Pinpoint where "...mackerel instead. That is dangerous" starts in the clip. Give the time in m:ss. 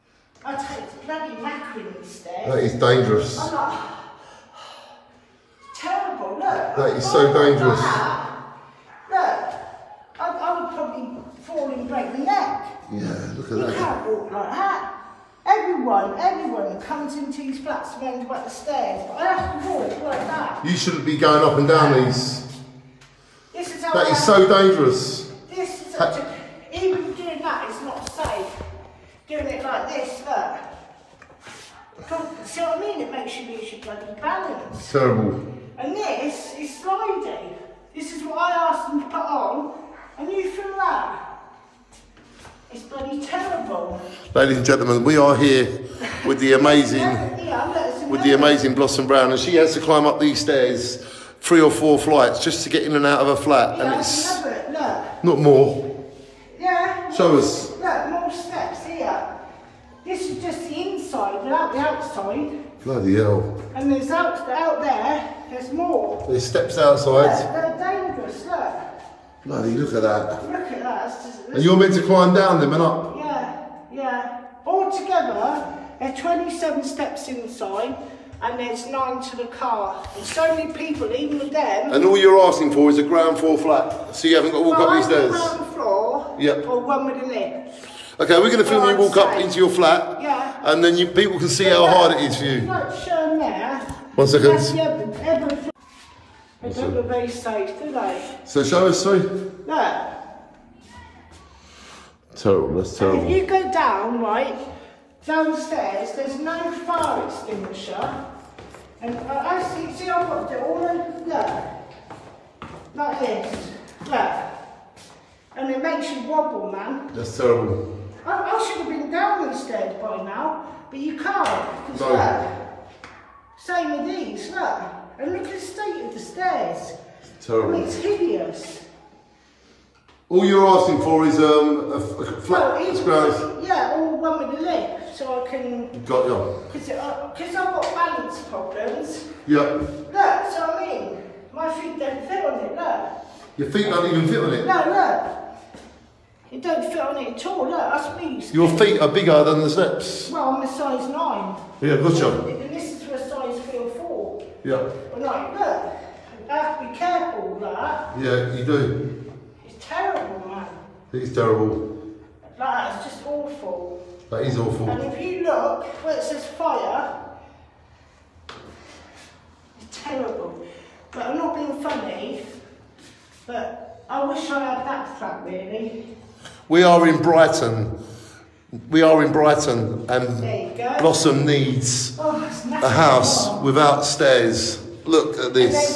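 0:01.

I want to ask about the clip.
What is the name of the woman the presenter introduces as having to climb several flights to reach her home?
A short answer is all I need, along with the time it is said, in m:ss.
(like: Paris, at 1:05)
Blossom Brown, at 0:48.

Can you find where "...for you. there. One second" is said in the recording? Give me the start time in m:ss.
1:32.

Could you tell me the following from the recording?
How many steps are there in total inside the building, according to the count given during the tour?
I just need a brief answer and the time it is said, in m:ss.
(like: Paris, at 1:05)
27, at 1:16.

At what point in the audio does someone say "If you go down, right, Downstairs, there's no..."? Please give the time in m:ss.
1:43.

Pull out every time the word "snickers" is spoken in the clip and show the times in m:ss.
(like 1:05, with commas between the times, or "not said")
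not said.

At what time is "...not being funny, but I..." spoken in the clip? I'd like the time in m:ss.
2:51.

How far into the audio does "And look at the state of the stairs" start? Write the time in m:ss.
2:05.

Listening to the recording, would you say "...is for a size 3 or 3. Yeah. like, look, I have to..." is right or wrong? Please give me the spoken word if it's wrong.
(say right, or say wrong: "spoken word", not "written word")
wrong: "4", not "3".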